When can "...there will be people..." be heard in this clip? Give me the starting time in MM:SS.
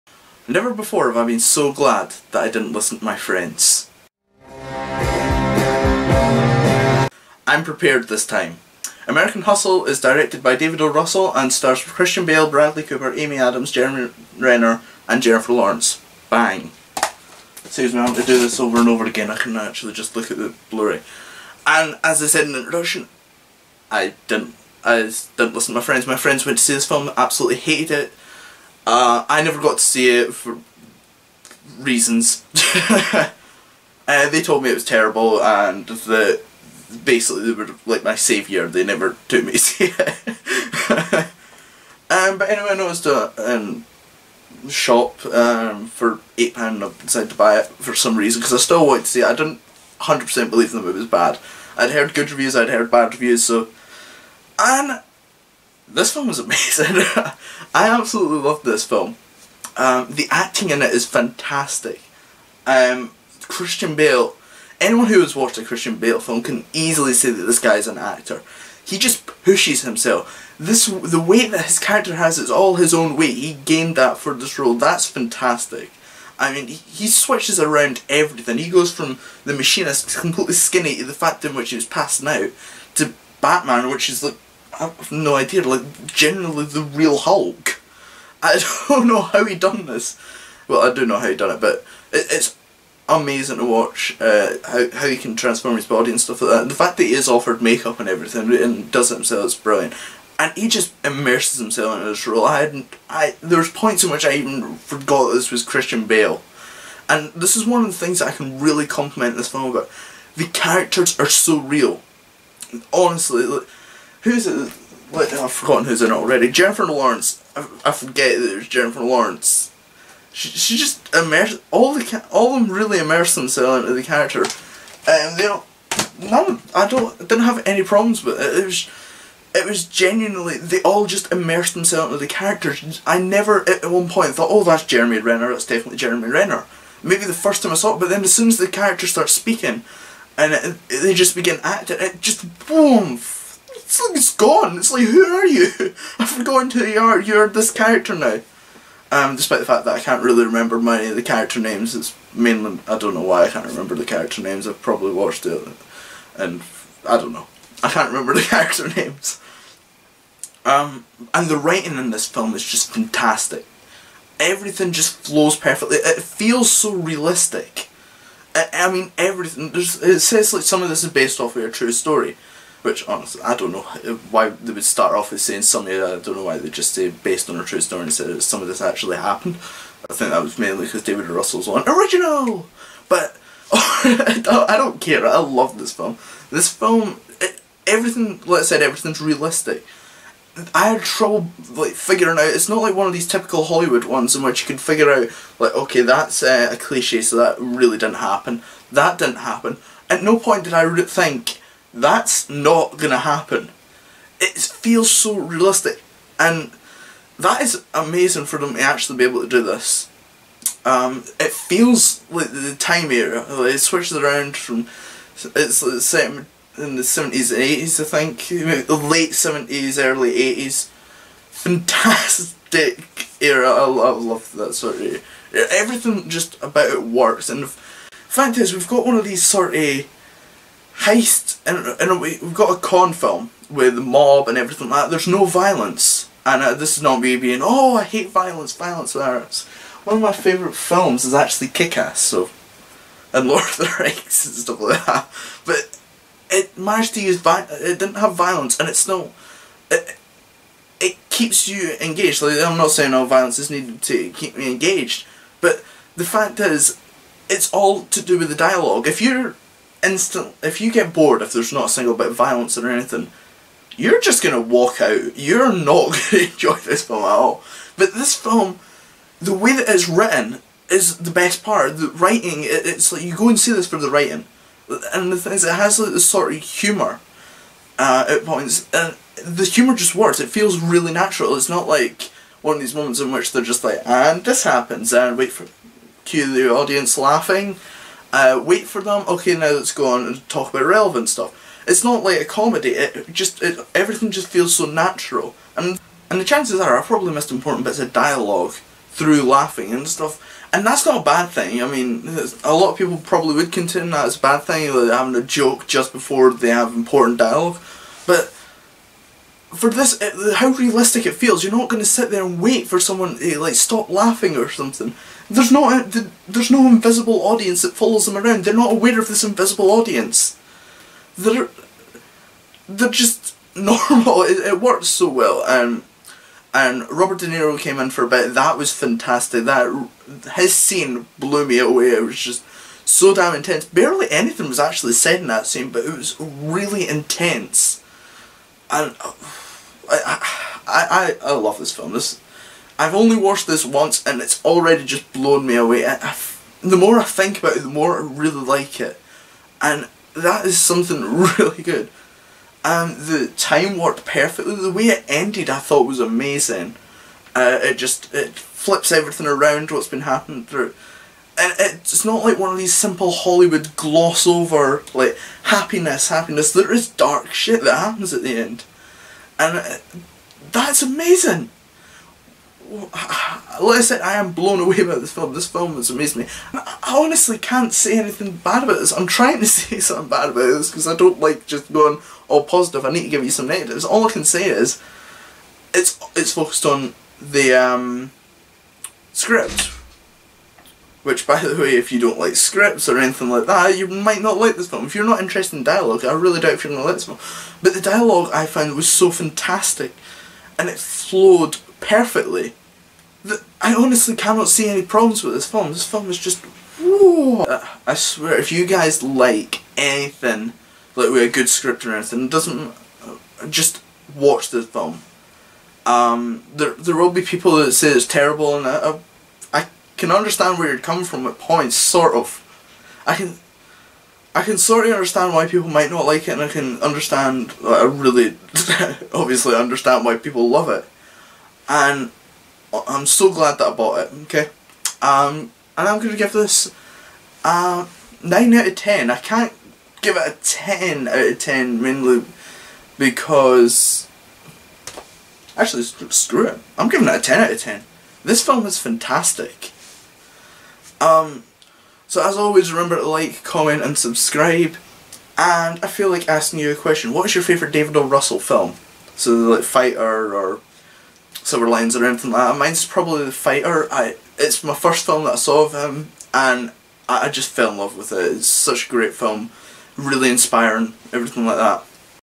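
06:56.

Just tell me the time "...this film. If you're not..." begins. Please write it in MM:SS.
06:34.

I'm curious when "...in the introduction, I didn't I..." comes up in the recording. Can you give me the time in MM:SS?
00:22.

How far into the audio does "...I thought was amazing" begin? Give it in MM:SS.
05:55.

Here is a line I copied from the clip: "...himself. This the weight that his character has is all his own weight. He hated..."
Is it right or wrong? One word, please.
wrong.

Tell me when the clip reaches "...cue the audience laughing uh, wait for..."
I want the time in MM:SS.
04:46.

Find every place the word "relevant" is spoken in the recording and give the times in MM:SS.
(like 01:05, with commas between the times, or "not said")
04:50.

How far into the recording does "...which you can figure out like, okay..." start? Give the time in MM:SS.
03:14.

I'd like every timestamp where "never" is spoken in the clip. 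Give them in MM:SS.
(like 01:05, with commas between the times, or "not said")
00:00, 00:29, 00:38, 02:13.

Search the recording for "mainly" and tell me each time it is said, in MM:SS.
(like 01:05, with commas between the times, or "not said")
02:32, 03:00, 07:22.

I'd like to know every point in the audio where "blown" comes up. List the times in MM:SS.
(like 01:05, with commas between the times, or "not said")
05:45, 06:14.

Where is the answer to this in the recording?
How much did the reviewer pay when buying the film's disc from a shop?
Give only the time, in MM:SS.
00:46.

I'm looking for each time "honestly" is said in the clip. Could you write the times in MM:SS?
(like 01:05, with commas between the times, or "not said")
01:52, 02:53, 06:17, 06:43.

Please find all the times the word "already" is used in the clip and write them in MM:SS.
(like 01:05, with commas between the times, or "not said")
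01:56, 05:44.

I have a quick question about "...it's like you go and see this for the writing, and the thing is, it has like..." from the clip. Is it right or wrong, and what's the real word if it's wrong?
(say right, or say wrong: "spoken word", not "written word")
right.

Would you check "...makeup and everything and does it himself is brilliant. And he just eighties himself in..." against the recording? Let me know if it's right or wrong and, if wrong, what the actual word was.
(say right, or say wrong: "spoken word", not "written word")
wrong: "immerses", not "eighties".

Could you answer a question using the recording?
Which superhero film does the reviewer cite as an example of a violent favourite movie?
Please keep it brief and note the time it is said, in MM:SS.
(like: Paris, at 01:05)
Kick-Ass, at 04:01.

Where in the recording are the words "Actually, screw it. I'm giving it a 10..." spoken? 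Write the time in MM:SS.
07:25.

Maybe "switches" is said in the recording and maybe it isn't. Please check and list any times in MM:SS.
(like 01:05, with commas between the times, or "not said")
01:17, 03:33.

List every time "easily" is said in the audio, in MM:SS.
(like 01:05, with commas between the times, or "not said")
01:06.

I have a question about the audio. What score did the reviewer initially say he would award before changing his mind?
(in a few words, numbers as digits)
9 out of 10.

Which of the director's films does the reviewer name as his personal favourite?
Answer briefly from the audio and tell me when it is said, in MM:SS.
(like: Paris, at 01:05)
The Fighter, at 07:43.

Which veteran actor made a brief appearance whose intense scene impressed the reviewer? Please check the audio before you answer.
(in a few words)
Robert De Niro.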